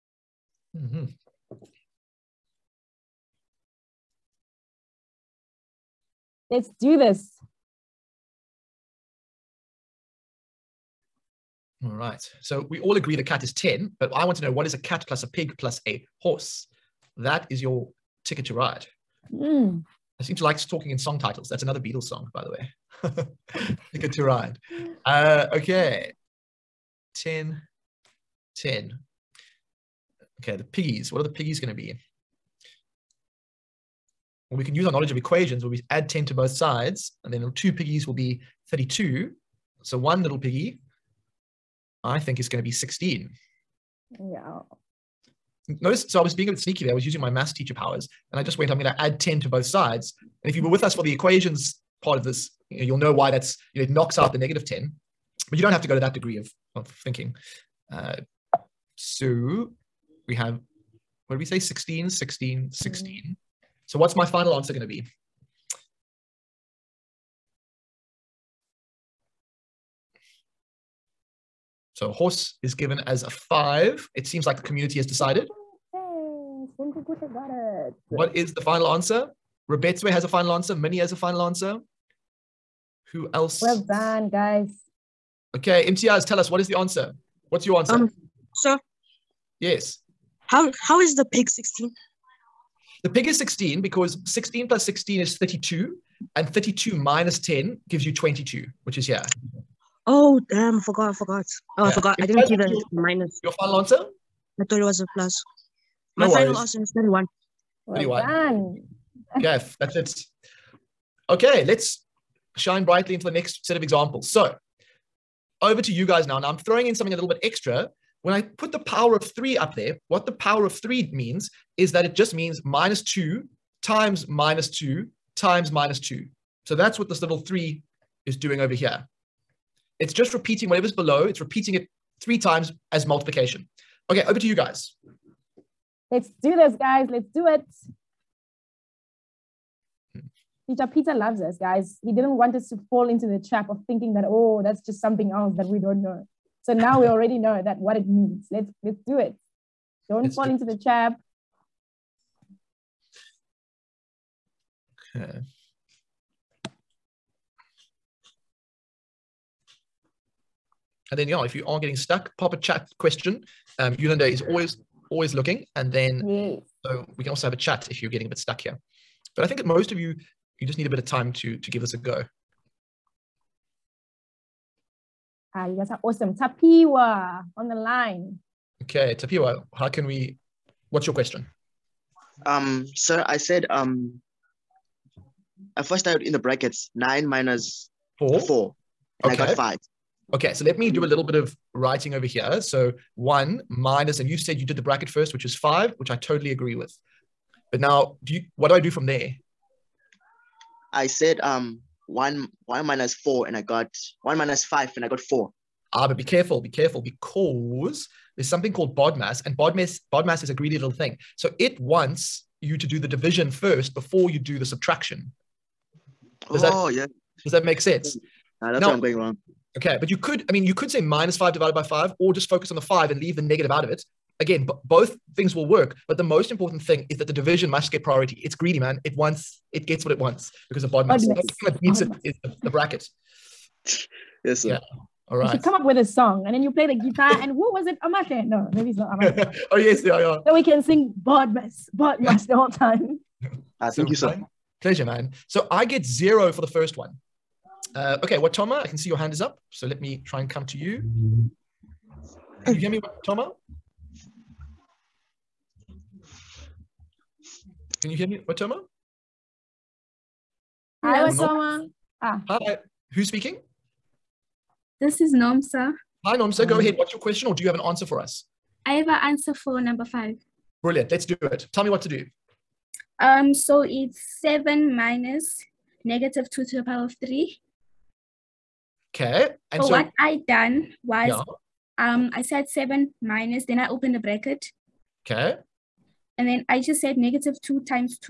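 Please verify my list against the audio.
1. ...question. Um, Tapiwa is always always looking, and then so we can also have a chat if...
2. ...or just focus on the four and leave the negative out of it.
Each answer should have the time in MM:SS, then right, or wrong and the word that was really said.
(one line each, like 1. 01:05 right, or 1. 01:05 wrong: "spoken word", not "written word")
1. 02:42 wrong: "Yolanda", not "Tapiwa"
2. 03:42 wrong: "five", not "four".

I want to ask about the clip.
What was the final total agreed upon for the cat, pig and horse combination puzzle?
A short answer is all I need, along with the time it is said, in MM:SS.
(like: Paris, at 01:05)
31, at 01:46.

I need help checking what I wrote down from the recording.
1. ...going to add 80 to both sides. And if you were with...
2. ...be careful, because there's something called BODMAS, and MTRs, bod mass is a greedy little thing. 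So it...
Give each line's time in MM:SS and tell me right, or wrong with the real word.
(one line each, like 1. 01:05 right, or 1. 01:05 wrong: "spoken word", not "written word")
1. 00:48 wrong: "10", not "80"
2. 03:26 wrong: "BODMAS", not "MTRs".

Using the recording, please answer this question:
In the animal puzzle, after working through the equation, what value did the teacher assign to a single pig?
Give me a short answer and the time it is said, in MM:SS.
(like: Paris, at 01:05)
16, at 00:39.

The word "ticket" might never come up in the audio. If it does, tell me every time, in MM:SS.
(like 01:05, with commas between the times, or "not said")
00:18, 00:23.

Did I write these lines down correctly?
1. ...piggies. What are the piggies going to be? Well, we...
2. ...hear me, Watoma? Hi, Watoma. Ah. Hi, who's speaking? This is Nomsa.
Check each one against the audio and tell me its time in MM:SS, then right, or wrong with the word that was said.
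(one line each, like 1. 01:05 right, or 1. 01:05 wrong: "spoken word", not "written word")
1. 00:30 right
2. 04:18 right.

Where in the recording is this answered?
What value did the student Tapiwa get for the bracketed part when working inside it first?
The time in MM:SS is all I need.
03:09.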